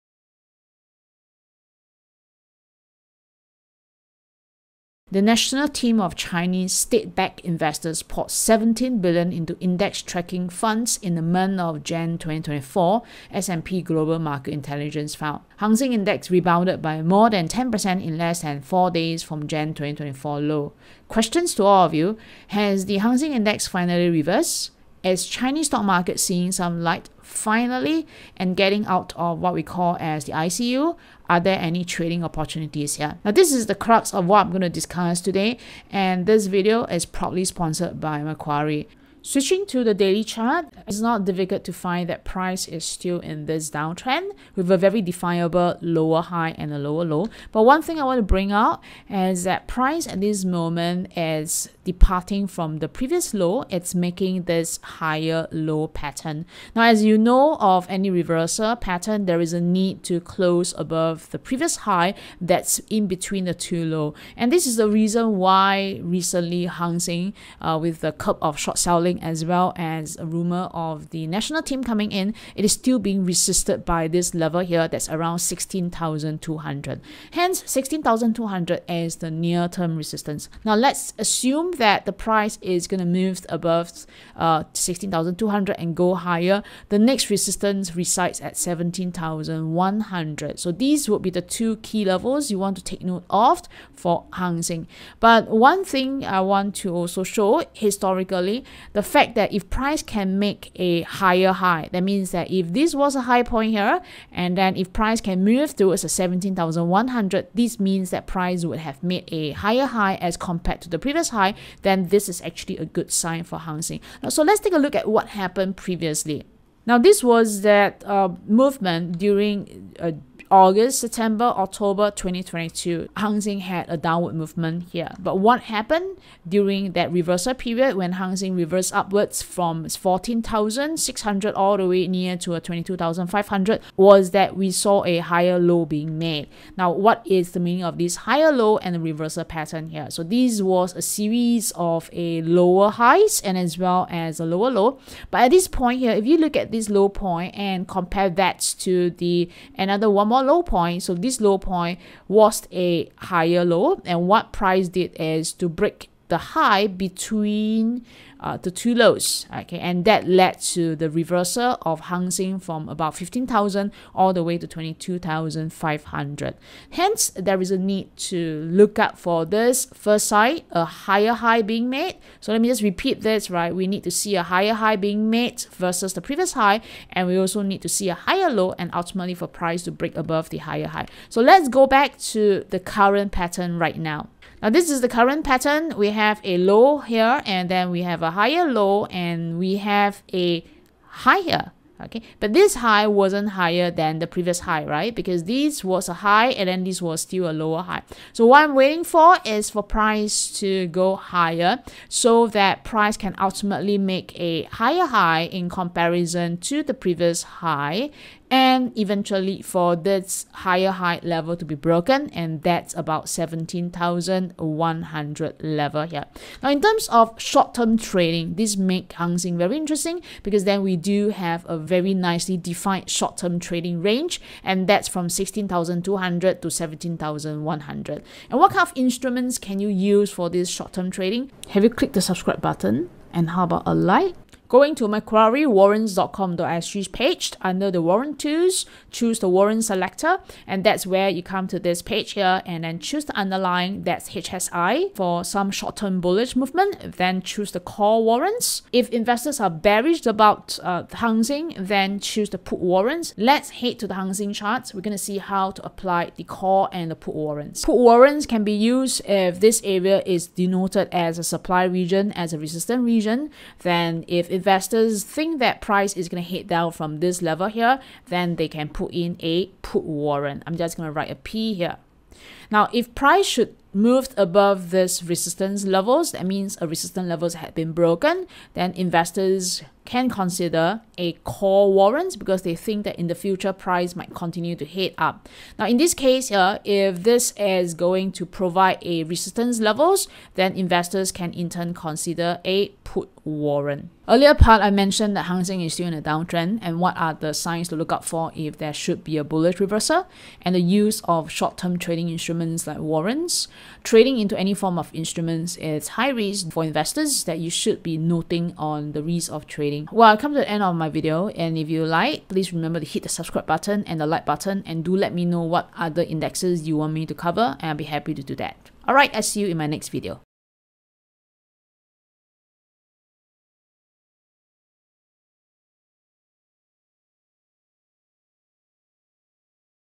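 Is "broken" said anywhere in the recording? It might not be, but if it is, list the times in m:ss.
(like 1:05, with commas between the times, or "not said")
3:31, 4:37.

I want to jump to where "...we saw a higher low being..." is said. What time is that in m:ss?
2:14.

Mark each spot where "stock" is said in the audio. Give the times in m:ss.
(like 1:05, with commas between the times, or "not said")
0:25.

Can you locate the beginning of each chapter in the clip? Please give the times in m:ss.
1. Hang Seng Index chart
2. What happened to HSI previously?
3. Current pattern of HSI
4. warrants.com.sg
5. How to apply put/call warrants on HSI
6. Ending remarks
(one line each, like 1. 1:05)
1. 0:39
2. 1:54
3. 3:04
4. 3:54
5. 4:35
6. 4:54.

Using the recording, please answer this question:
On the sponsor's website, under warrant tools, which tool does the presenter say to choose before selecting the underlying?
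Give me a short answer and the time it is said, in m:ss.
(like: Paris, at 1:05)
warrant selector, at 3:59.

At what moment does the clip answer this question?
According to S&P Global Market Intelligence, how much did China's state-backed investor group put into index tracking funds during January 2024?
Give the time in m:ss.
0:08.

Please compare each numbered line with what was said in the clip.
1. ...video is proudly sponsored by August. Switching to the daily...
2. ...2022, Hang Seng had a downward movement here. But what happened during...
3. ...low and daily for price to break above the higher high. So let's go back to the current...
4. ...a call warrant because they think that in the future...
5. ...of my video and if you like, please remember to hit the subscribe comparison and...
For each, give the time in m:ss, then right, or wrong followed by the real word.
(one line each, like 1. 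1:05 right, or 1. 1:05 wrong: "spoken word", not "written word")
1. 0:36 wrong: "Macquarie", not "August"
2. 2:02 right
3. 2:58 wrong: "ultimately", not "daily"
4. 4:41 right
5. 5:10 wrong: "button", not "comparison".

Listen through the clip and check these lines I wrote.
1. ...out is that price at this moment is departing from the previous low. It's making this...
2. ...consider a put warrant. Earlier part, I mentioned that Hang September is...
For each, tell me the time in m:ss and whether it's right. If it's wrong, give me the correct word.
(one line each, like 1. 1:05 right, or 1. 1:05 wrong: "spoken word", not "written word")
1. 0:48 right
2. 4:51 wrong: "Seng", not "September".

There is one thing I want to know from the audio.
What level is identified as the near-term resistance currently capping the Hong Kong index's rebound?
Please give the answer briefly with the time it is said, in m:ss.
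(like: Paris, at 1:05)
16,200, at 1:15.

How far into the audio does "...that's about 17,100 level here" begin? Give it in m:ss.
3:32.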